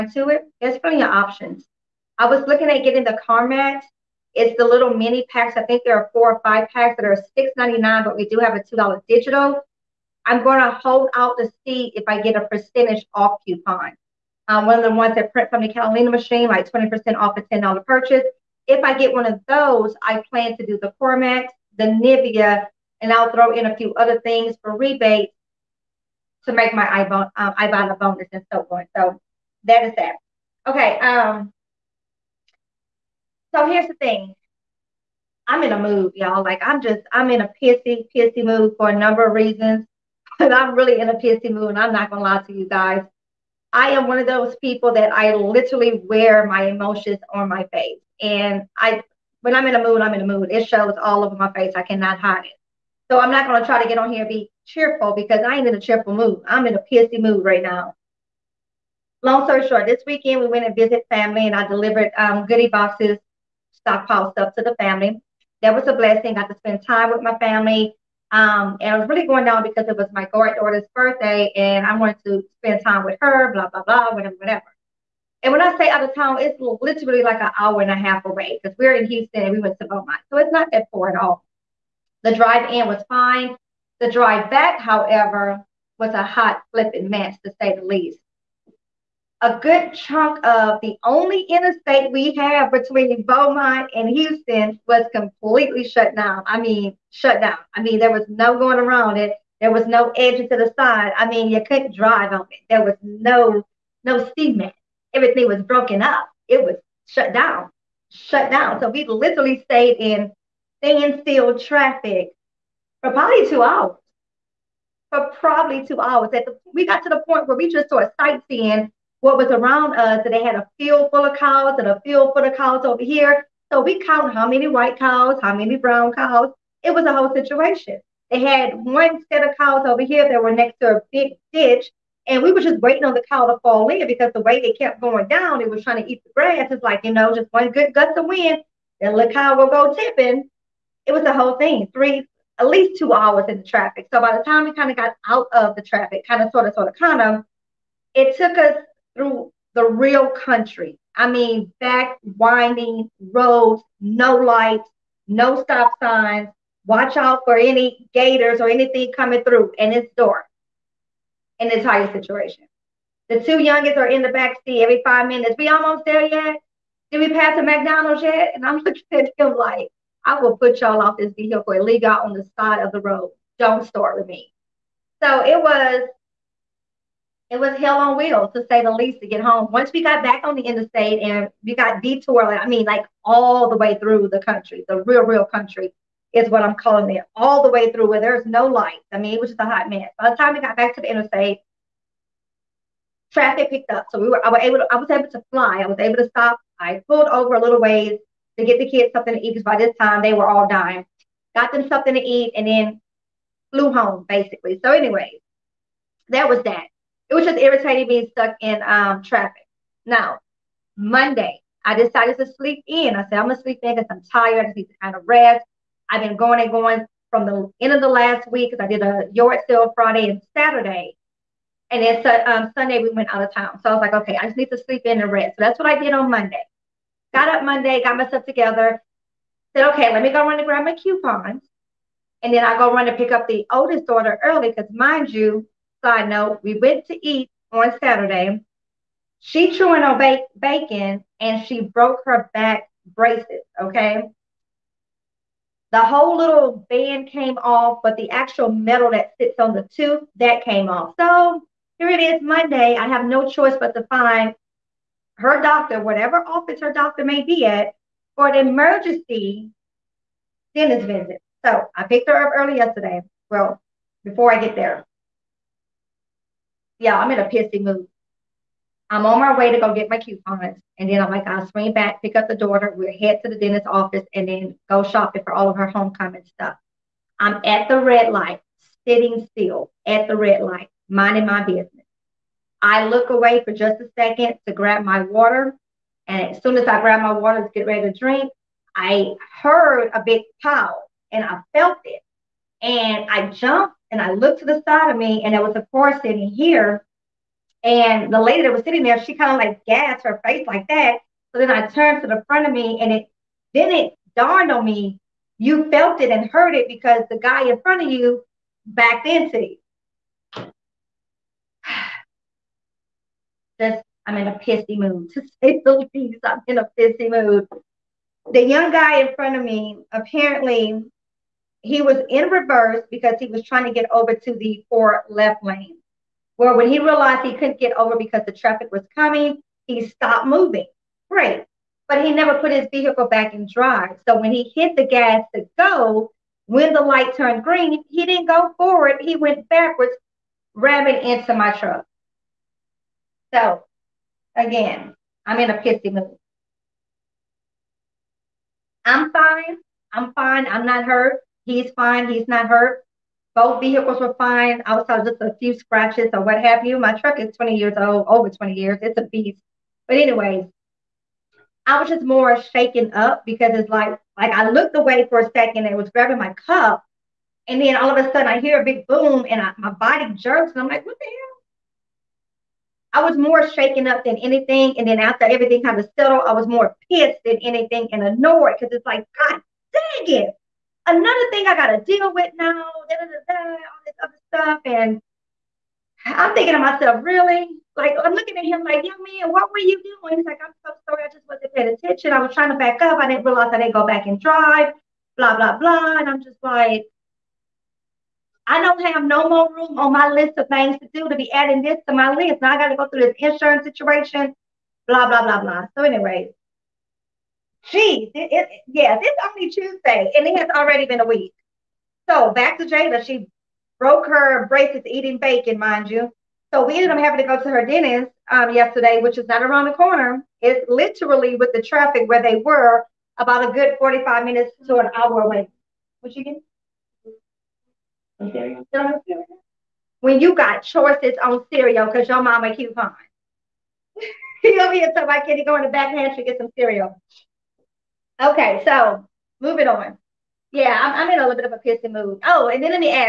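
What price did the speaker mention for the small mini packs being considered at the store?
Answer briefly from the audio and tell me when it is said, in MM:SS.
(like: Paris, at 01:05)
$6.99, at 00:07.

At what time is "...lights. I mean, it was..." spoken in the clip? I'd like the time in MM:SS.
03:08.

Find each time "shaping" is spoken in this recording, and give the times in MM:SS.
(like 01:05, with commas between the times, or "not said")
not said.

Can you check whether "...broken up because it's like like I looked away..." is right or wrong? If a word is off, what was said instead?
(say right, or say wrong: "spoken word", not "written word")
wrong: "shaken", not "broken".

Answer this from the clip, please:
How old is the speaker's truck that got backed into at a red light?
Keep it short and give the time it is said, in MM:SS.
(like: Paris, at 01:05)
over 20 years, at 05:58.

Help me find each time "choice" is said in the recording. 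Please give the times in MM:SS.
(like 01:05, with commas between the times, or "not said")
04:13, 07:10.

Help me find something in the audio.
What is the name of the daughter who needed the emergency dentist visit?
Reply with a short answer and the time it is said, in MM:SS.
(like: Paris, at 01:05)
Jada, at 06:52.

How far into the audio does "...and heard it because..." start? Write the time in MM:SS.
05:06.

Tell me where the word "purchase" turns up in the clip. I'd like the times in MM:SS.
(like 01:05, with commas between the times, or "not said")
00:17.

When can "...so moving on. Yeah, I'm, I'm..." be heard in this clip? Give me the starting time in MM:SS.
07:18.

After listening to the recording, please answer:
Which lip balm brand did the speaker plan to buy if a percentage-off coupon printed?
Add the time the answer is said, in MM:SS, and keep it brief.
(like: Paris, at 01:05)
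Carmex, at 00:21.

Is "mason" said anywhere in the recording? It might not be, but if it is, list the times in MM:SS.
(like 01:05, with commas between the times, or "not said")
not said.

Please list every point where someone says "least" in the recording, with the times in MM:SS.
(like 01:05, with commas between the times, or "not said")
01:27, 02:22, 02:58, 05:16.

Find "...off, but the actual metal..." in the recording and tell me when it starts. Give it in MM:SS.
04:07.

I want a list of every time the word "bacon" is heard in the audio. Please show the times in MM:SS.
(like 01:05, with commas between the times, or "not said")
04:00, 06:55.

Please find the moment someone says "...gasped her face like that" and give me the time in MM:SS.
04:59.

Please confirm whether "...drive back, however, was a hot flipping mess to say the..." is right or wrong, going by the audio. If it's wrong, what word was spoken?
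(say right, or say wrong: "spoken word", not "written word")
right.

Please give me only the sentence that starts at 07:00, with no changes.
It's literally with the traffic where they were about a good 45 minutes to an hour away.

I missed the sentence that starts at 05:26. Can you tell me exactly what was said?
Where when he realized he couldn't get over because the traffic was coming, he stopped moving.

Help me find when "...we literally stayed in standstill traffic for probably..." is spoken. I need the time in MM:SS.
01:48.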